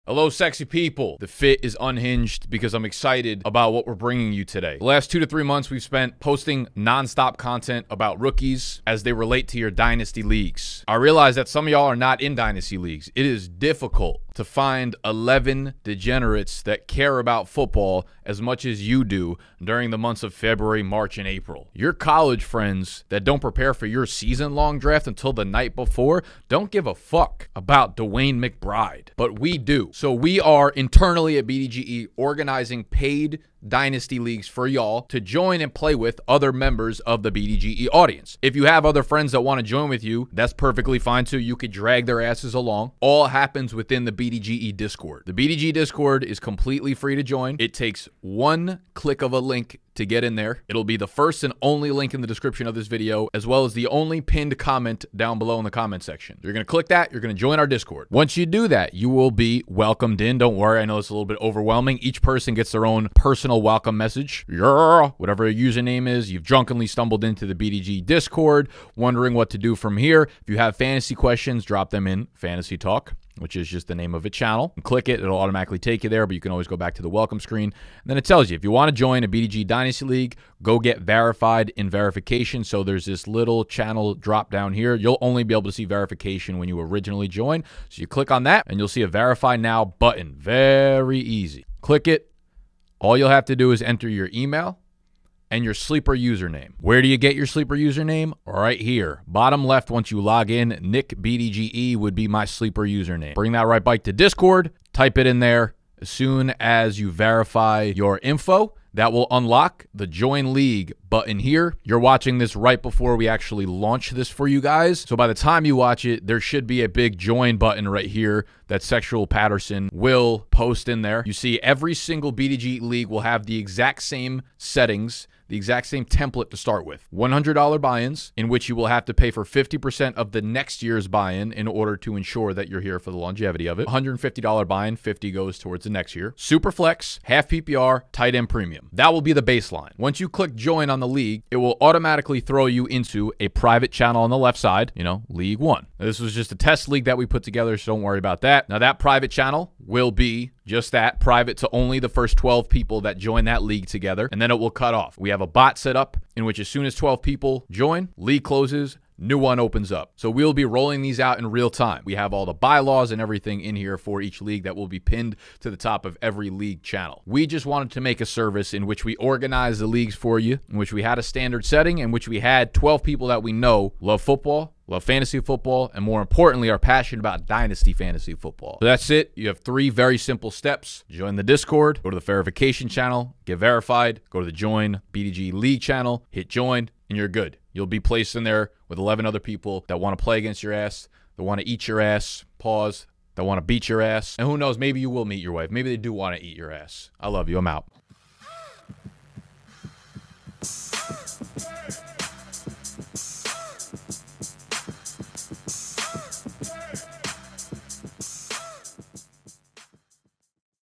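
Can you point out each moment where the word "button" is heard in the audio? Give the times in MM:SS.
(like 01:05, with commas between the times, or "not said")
01:29, 01:51, 01:57.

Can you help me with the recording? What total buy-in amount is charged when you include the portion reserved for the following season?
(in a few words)
$150.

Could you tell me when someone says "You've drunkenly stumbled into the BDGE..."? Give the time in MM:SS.
01:06.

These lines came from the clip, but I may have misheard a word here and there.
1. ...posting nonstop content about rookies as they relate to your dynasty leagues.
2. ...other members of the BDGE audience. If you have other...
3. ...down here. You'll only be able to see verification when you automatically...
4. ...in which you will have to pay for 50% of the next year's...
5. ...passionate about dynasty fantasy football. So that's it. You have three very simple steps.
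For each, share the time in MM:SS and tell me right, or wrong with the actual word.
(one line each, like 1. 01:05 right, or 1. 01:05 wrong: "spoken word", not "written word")
1. 00:06 right
2. 00:36 right
3. 01:24 wrong: "originally", not "automatically"
4. 02:08 right
5. 02:56 right.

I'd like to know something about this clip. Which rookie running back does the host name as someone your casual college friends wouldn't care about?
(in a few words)
DeWayne McBride.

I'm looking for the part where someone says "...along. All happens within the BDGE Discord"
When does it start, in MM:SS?
00:42.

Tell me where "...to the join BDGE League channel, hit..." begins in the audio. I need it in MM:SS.
03:04.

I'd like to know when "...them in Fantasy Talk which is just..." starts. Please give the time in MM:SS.
01:11.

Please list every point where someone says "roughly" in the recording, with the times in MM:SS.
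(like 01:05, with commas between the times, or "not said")
not said.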